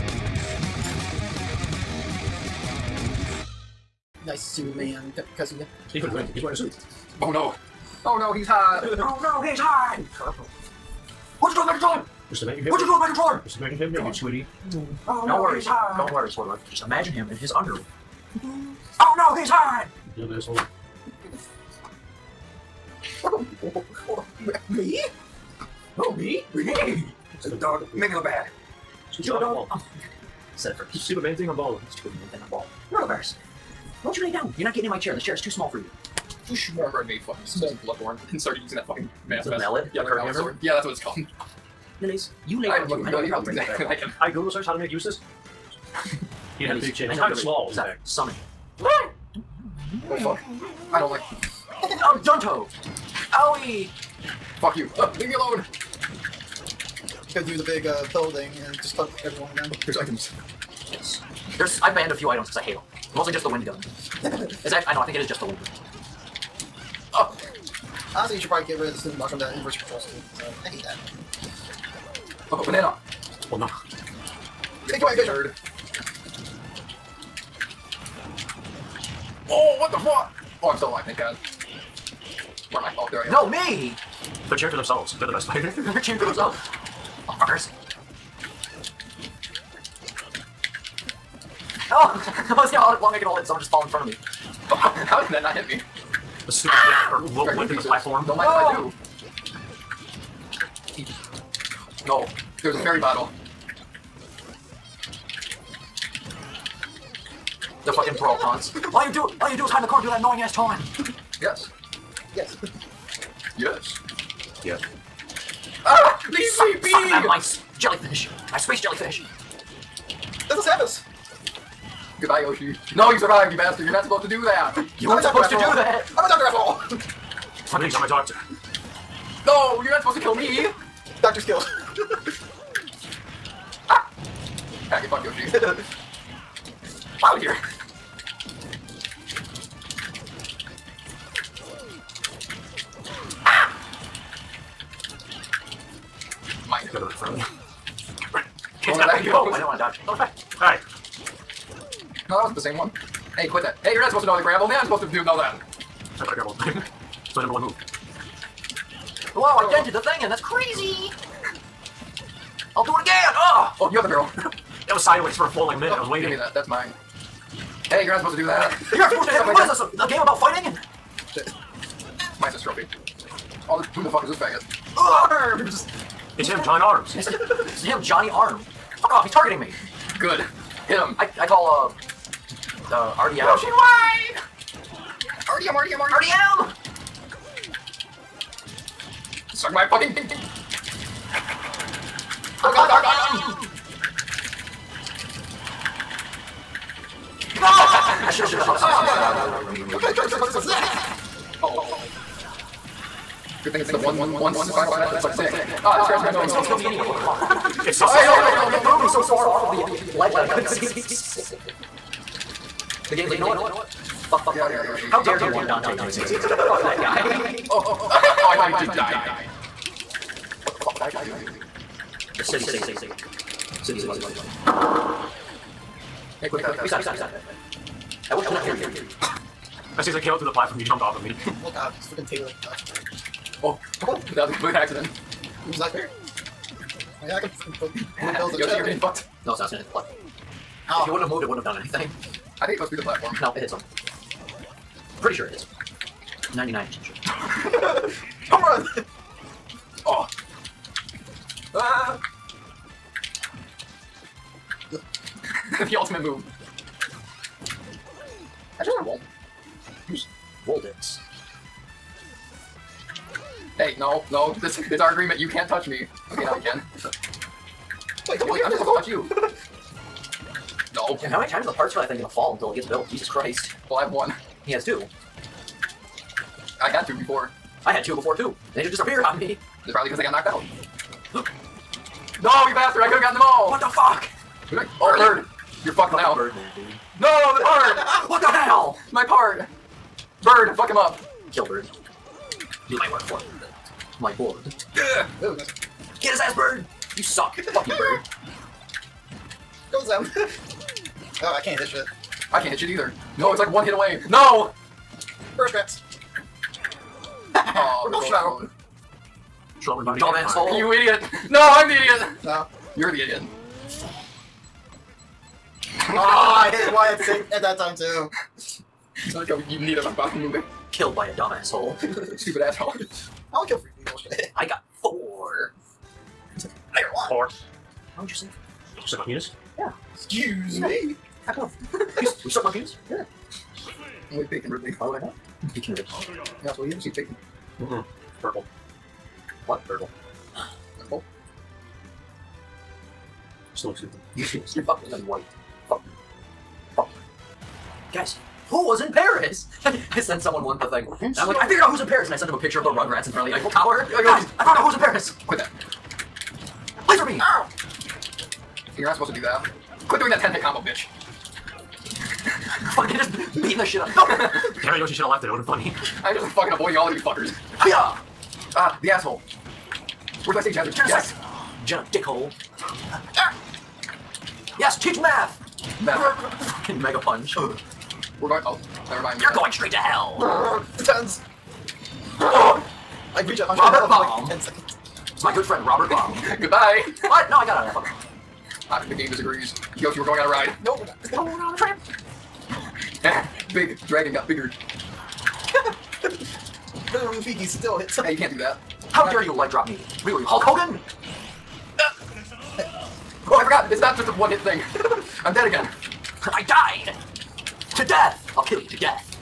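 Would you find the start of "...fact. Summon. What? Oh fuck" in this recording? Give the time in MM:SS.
00:47.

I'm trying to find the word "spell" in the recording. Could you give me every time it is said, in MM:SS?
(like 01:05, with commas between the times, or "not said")
not said.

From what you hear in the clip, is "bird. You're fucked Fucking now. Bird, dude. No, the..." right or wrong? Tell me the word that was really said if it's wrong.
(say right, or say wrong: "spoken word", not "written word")
right.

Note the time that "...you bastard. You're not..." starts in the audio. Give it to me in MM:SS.
02:03.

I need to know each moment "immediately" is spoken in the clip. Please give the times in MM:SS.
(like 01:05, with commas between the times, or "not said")
03:19.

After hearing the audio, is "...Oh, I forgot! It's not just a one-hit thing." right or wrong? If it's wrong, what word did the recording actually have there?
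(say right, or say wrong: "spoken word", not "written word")
right.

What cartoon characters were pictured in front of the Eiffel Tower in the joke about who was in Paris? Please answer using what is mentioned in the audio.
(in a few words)
the Rugrats.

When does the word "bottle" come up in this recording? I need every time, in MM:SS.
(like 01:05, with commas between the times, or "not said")
01:42.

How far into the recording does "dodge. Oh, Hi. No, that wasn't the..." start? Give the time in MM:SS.
02:29.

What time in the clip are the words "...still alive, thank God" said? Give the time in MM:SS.
01:20.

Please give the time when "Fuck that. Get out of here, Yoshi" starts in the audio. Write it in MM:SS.
03:34.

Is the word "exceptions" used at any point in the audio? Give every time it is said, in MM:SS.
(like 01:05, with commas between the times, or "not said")
not said.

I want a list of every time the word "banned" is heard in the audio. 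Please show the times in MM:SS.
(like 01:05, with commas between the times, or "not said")
01:01.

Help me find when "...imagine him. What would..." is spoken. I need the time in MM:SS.
00:12.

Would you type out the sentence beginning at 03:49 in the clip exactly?
As soon as I came up through the platform, you jumped off of me.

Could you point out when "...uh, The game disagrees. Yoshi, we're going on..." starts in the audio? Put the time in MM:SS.
06:28.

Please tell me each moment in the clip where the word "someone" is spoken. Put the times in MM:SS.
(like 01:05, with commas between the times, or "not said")
01:33, 05:50.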